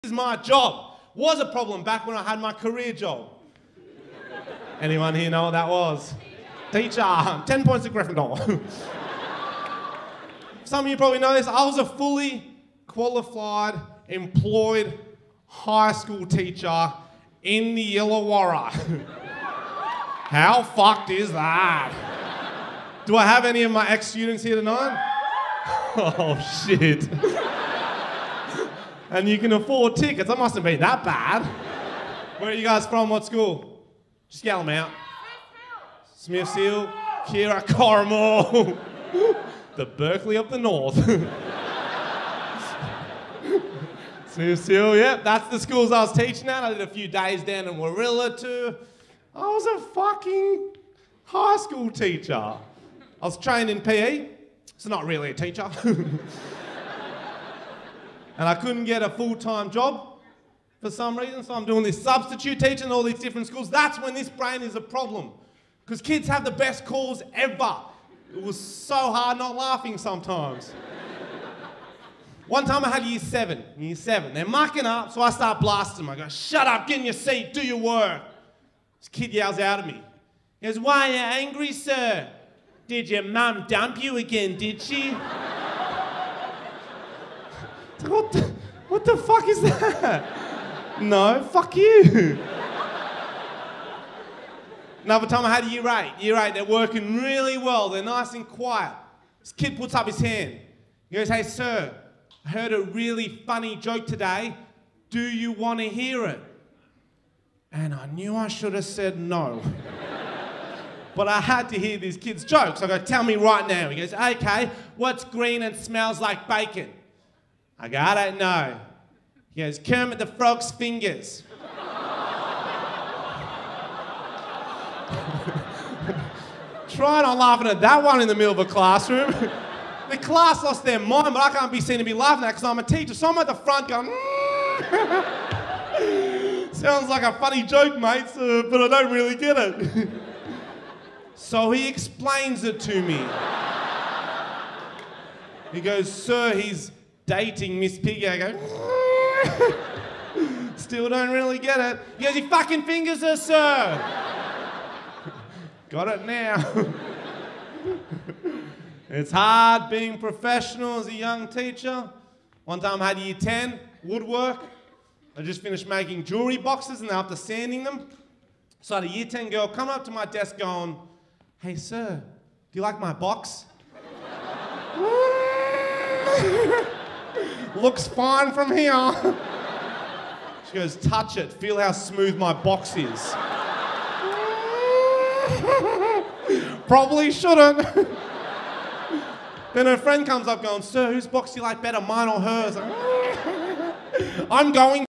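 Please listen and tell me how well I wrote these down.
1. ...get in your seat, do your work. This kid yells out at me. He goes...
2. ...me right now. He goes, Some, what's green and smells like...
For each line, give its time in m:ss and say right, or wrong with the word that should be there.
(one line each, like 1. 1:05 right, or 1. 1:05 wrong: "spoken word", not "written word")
1. 1:16 right
2. 1:53 wrong: "Okay", not "Some".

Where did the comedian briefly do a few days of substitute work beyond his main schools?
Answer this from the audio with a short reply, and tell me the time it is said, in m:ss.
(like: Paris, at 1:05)
Warilla, at 0:47.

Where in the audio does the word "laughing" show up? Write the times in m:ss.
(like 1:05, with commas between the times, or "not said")
1:09, 2:07, 2:12.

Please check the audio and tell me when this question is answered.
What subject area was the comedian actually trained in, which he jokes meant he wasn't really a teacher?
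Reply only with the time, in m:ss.
0:53.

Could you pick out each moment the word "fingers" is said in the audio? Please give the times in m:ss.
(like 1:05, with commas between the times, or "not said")
2:00, 2:32.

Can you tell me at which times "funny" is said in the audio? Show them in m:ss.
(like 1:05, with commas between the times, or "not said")
1:43, 2:17.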